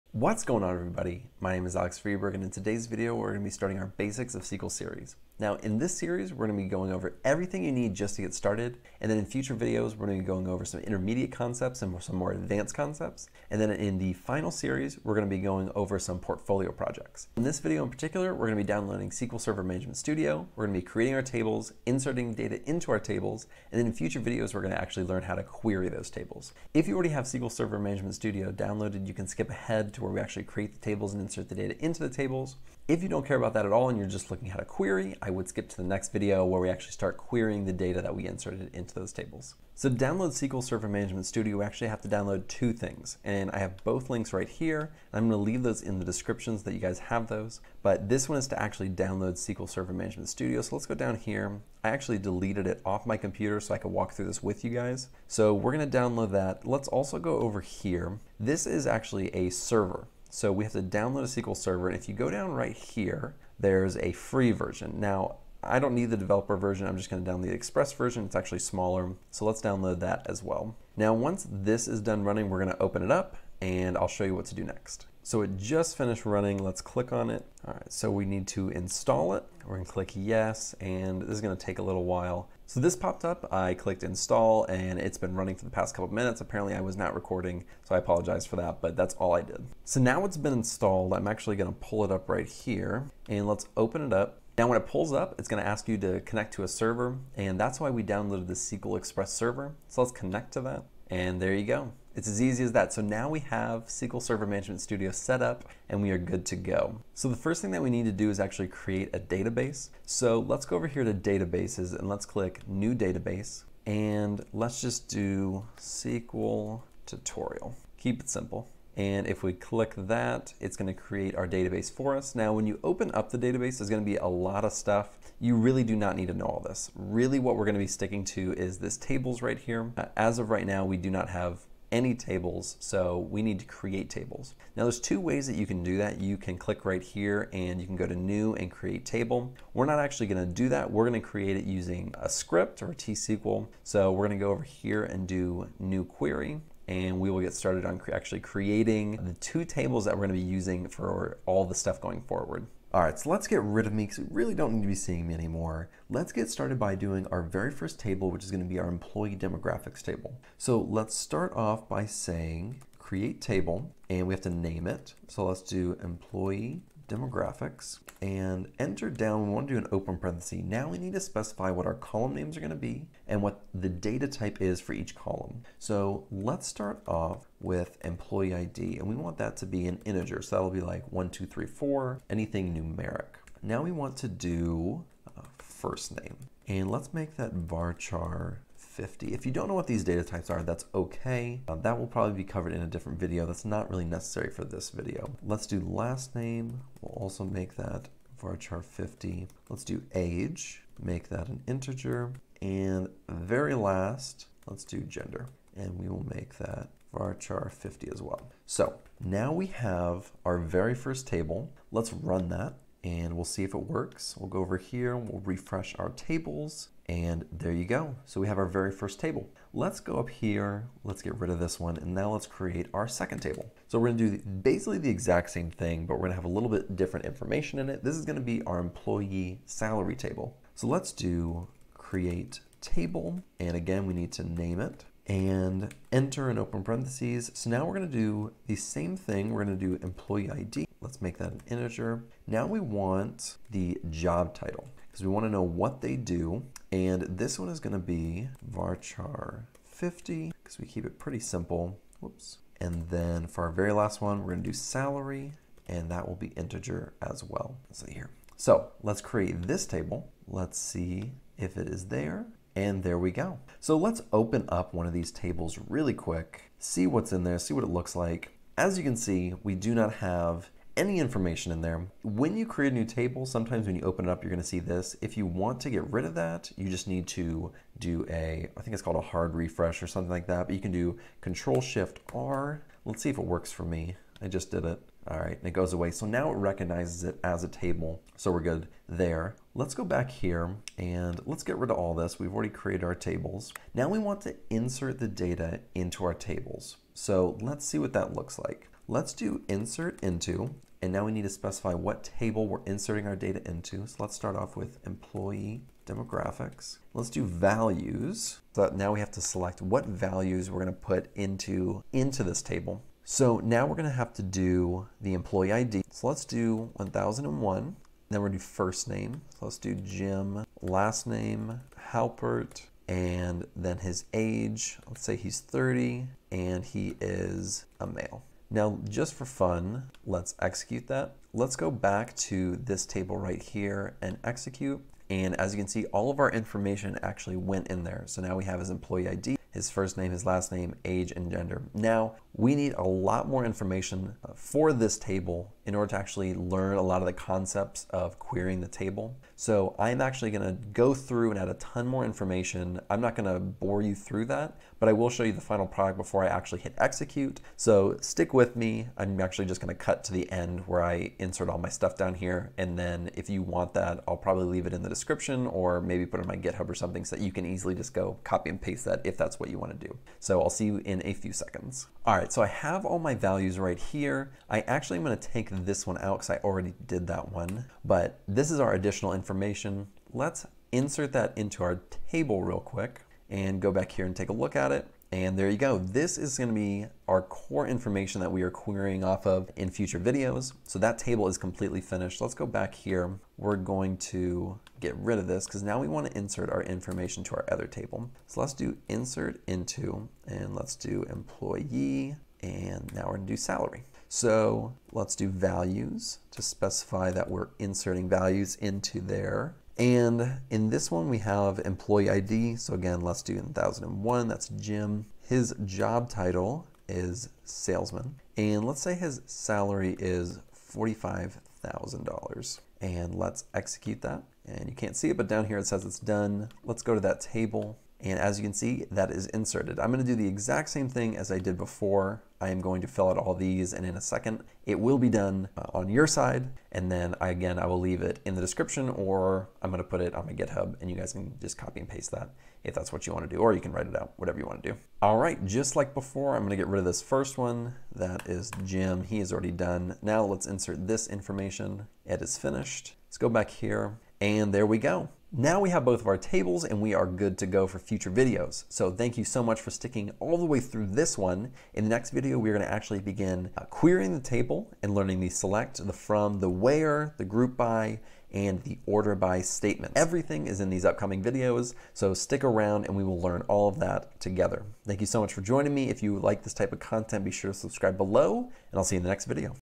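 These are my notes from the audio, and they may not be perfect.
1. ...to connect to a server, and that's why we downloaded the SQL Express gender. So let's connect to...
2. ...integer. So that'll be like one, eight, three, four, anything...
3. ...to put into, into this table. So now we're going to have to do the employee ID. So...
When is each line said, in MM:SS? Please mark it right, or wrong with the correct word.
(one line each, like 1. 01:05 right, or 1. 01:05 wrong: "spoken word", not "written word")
1. 01:35 wrong: "server", not "gender"
2. 03:00 wrong: "two", not "eight"
3. 05:10 right.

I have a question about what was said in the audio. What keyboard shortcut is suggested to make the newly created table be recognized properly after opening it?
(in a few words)
Control Shift R.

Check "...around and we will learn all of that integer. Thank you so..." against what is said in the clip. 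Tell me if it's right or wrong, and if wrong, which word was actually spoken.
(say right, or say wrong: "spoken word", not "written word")
wrong: "together", not "integer".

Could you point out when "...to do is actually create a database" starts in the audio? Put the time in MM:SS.
01:48.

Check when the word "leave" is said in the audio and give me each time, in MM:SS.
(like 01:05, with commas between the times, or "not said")
00:45, 06:04, 07:17.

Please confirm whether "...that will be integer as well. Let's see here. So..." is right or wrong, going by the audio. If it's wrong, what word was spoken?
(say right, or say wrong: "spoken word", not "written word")
right.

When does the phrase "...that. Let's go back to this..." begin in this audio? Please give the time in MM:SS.
05:31.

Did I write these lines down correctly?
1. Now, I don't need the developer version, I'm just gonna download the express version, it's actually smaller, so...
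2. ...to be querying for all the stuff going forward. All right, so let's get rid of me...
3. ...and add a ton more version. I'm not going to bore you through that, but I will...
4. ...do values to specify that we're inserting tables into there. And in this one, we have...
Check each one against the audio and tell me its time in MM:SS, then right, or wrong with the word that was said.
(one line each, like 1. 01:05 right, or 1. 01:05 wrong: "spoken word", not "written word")
1. 01:04 right
2. 02:30 wrong: "using", not "querying"
3. 05:51 wrong: "information", not "version"
4. 06:45 wrong: "values", not "tables".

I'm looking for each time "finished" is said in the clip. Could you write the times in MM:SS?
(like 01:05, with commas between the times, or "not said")
01:15, 06:32, 07:32.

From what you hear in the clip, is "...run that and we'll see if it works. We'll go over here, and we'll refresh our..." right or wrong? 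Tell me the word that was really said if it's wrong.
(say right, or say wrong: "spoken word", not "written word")
right.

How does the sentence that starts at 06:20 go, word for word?
Let's insert that into our table real quick and go back here and take a look at it.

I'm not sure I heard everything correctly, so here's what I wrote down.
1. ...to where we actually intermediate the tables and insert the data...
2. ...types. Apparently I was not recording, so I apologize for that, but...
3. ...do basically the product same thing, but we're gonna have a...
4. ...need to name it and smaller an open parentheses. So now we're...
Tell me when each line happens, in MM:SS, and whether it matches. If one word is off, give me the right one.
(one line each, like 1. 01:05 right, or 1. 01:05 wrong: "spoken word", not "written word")
1. 00:29 wrong: "create", not "intermediate"
2. 01:26 wrong: "minutes", not "types"
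3. 03:44 wrong: "exact", not "product"
4. 03:54 wrong: "enter", not "smaller".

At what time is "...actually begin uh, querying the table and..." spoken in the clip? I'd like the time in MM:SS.
07:42.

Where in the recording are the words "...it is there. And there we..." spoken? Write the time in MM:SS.
04:21.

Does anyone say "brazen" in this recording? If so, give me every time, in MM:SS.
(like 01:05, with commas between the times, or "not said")
not said.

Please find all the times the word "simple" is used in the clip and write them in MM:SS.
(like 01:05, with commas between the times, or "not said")
01:58, 04:11.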